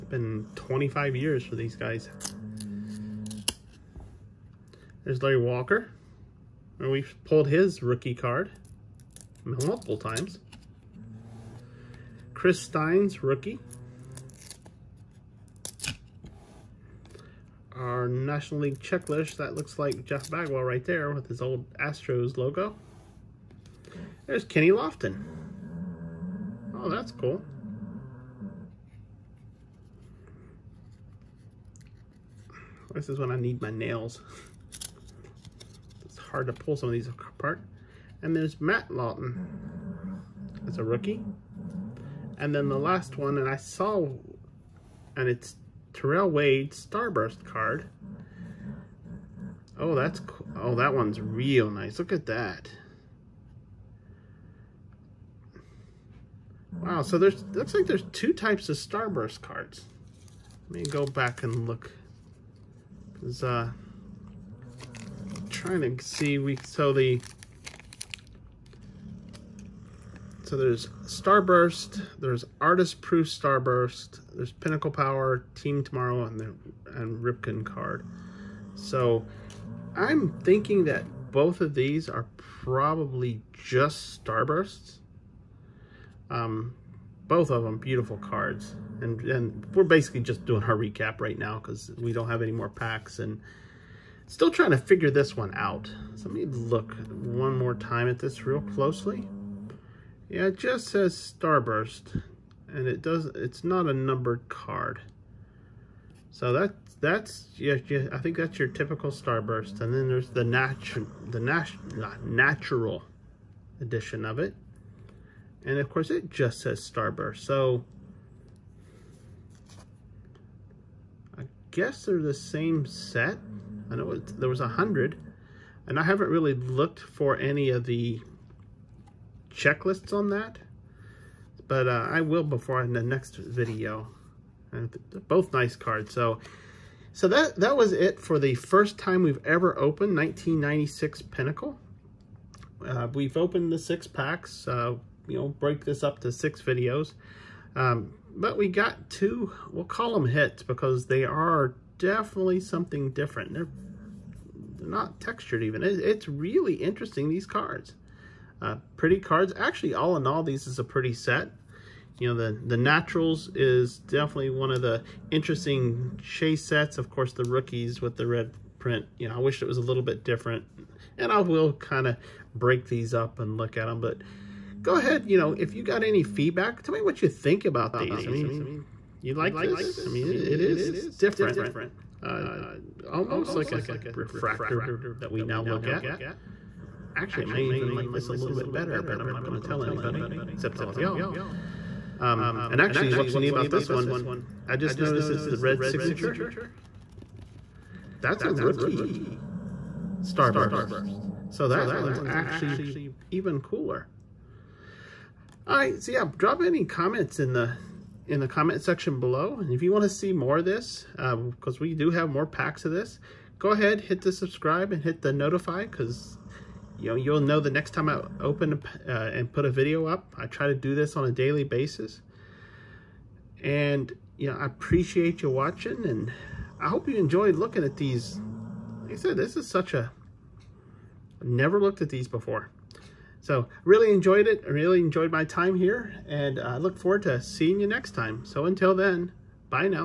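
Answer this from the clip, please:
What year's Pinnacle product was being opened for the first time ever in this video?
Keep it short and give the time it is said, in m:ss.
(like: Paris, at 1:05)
1996, at 2:20.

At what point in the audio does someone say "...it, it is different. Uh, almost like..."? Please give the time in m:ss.
3:00.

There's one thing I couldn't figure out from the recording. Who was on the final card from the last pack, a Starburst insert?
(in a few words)
Terrell Wade.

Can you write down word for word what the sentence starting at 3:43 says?
And, you know, I appreciate you watching and I hope you enjoyed looking at these.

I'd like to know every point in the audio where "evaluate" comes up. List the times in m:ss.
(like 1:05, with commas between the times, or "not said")
not said.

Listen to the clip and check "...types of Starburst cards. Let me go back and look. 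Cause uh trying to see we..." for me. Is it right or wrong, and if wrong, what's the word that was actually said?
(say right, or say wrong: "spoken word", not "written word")
right.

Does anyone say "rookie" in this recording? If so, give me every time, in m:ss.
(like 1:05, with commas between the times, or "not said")
0:07, 0:13, 0:40, 2:47, 3:18.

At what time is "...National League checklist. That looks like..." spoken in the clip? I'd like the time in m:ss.
0:18.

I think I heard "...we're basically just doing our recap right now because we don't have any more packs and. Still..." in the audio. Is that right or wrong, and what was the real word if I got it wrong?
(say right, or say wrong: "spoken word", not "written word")
right.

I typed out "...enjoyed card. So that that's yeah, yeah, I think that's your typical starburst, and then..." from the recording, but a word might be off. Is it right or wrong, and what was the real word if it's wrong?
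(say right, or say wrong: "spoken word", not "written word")
wrong: "numbered", not "enjoyed".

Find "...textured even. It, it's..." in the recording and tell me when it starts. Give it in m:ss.
2:35.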